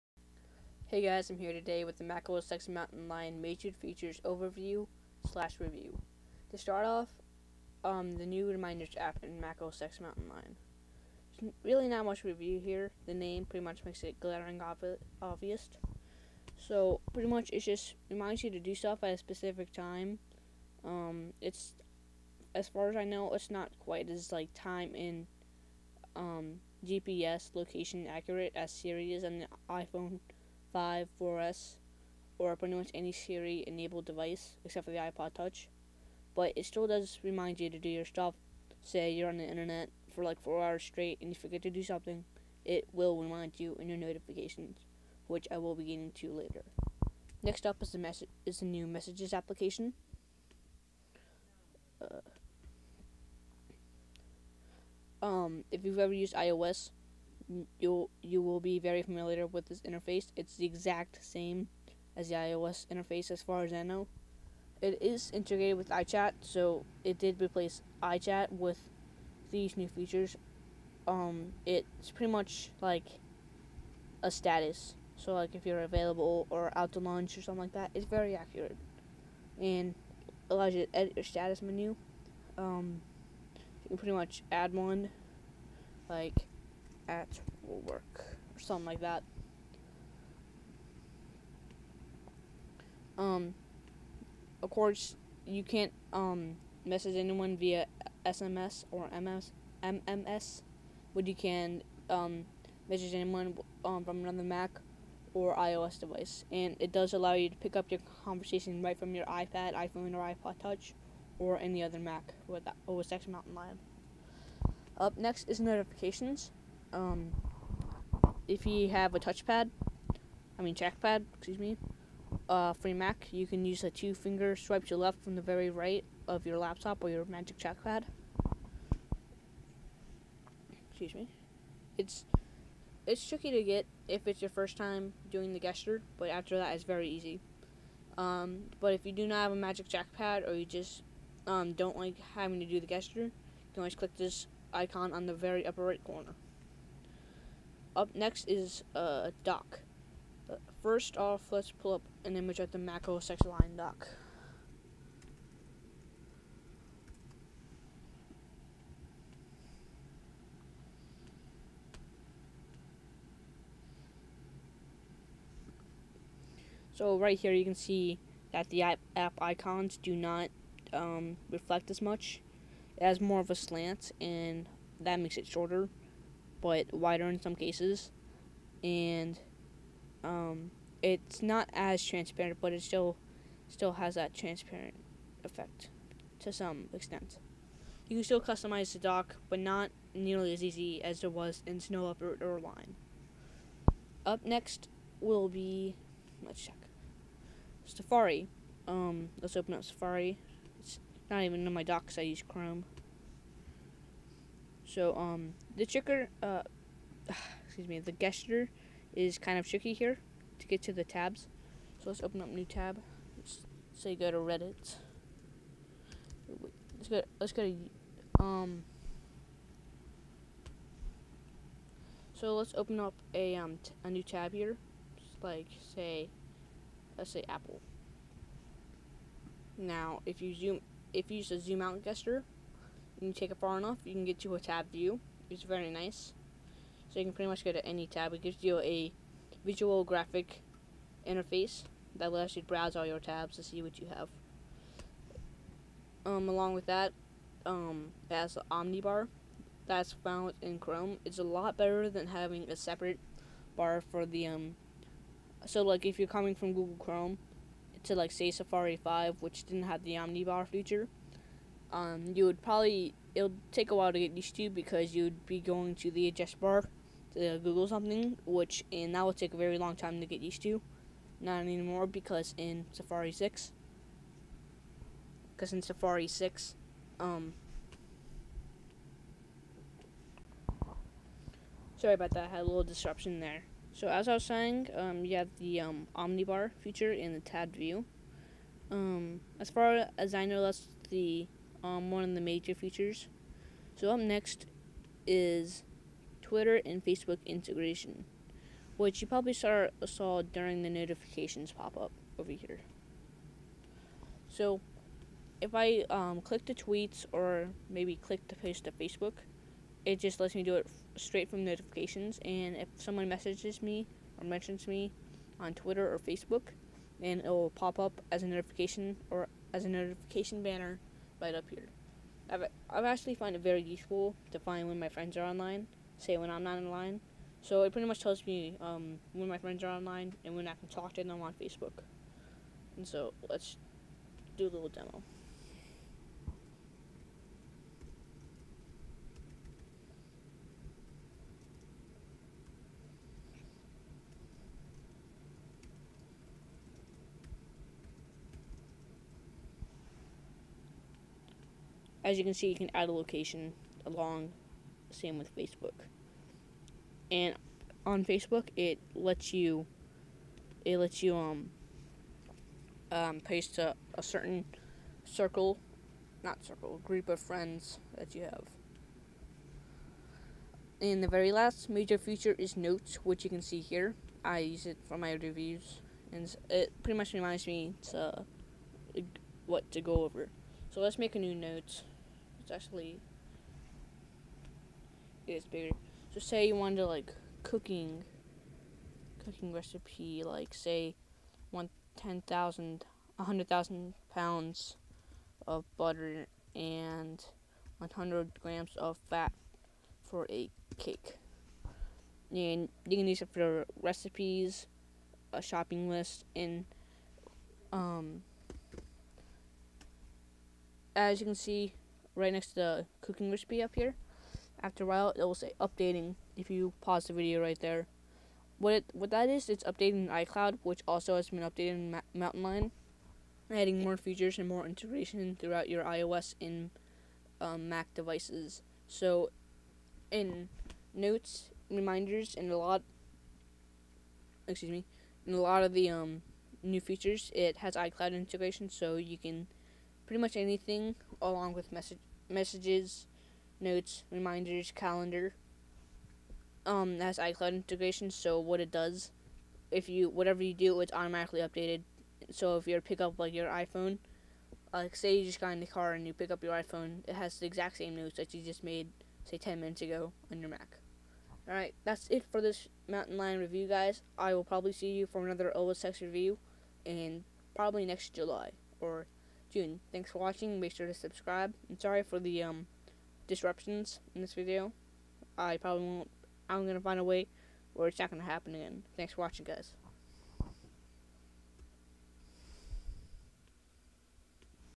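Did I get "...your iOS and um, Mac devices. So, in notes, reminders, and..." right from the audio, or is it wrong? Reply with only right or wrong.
right.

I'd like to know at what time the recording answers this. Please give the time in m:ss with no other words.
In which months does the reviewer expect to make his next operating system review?
7:48.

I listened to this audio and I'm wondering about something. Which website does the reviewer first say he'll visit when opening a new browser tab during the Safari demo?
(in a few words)
Reddit.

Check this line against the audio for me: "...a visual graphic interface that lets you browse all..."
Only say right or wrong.
right.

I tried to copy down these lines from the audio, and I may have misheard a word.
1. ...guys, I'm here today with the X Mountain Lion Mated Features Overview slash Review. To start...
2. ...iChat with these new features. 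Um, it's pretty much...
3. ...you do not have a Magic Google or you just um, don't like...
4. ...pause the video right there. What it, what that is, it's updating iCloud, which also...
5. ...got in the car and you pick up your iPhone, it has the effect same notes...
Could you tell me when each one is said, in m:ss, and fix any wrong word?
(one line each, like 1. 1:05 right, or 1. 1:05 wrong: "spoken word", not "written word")
1. 0:01 right
2. 1:08 right
3. 2:19 wrong: "Trackpad", not "Google"
4. 6:56 right
5. 7:35 wrong: "exact", not "effect".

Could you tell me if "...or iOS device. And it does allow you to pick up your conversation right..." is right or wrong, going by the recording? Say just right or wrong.
right.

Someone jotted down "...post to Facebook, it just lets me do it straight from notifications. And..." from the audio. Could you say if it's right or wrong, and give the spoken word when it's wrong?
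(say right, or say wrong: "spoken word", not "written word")
right.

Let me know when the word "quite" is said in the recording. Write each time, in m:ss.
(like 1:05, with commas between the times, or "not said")
0:23.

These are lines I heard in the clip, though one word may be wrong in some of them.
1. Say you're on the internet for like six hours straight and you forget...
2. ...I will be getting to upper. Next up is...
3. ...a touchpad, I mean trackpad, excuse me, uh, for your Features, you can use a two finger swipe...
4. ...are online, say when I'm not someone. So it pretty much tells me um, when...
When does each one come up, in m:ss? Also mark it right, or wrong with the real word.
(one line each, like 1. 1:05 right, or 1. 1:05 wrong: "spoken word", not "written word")
1. 0:38 wrong: "four", not "six"
2. 0:45 wrong: "later", not "upper"
3. 1:59 wrong: "Mac", not "Features"
4. 5:25 wrong: "online", not "someone".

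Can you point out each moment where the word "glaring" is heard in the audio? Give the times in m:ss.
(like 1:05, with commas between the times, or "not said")
0:14.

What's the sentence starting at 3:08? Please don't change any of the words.
You can still customize the dock, but not nearly as easy as there was in Snow Leopard or Lion.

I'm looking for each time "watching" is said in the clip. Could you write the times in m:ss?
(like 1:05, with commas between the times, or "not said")
7:50, 7:59.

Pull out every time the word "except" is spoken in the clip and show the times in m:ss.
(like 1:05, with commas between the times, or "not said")
0:34.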